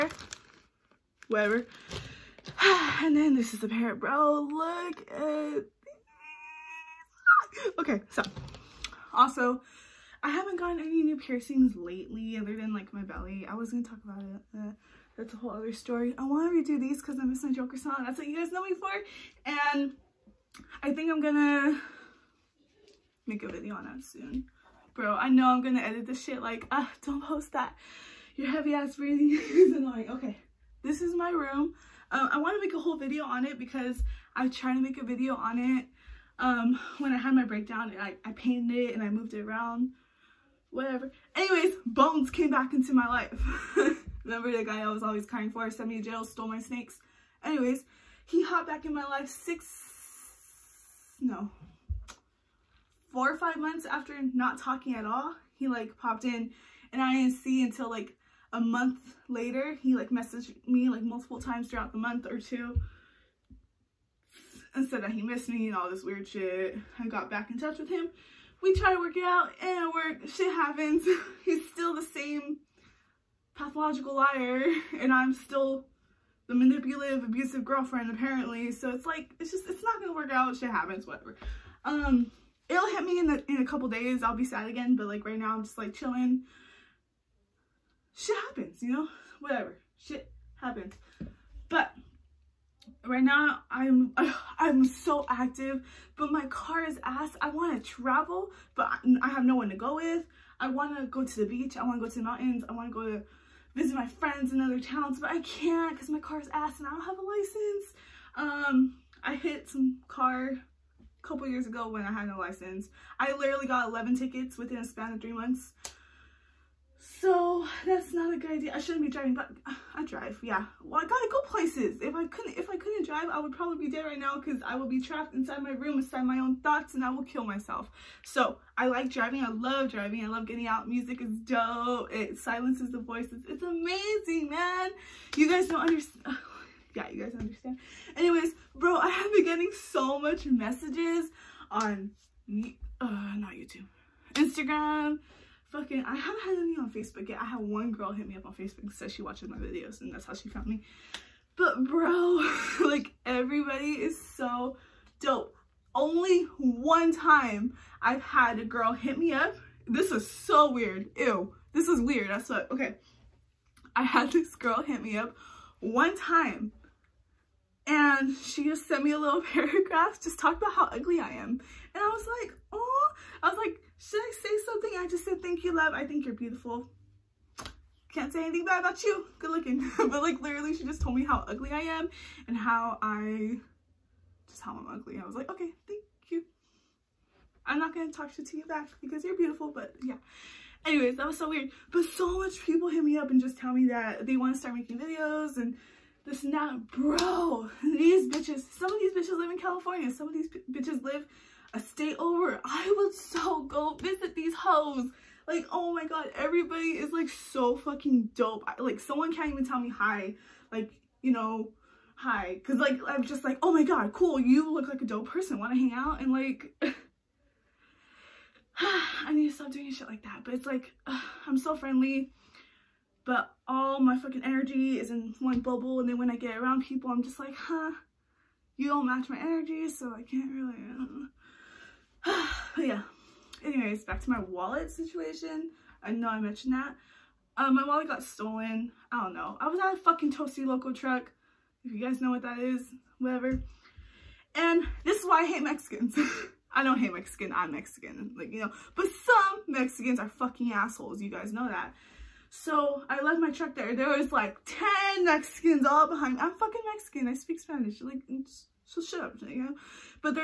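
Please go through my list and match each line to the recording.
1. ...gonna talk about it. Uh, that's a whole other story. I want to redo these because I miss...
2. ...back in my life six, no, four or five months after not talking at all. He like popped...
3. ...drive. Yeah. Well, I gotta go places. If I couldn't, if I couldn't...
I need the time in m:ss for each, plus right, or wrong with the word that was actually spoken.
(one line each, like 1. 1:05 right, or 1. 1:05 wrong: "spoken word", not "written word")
1. 0:13 right
2. 0:48 right
3. 2:00 right.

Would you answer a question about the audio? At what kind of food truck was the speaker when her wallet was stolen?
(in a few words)
Tostiloco truck.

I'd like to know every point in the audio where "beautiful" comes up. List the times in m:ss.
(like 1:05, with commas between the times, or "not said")
2:56, 3:09.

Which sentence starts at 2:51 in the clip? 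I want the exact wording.
And I was like, oh I was like, should I say something?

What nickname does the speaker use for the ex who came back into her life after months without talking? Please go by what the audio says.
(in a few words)
Bones.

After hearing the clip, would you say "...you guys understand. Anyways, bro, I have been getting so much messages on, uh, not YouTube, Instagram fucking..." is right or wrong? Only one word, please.
right.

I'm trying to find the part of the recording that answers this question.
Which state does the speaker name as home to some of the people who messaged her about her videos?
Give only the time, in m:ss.
3:19.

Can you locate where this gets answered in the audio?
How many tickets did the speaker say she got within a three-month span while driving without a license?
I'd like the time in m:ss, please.
1:53.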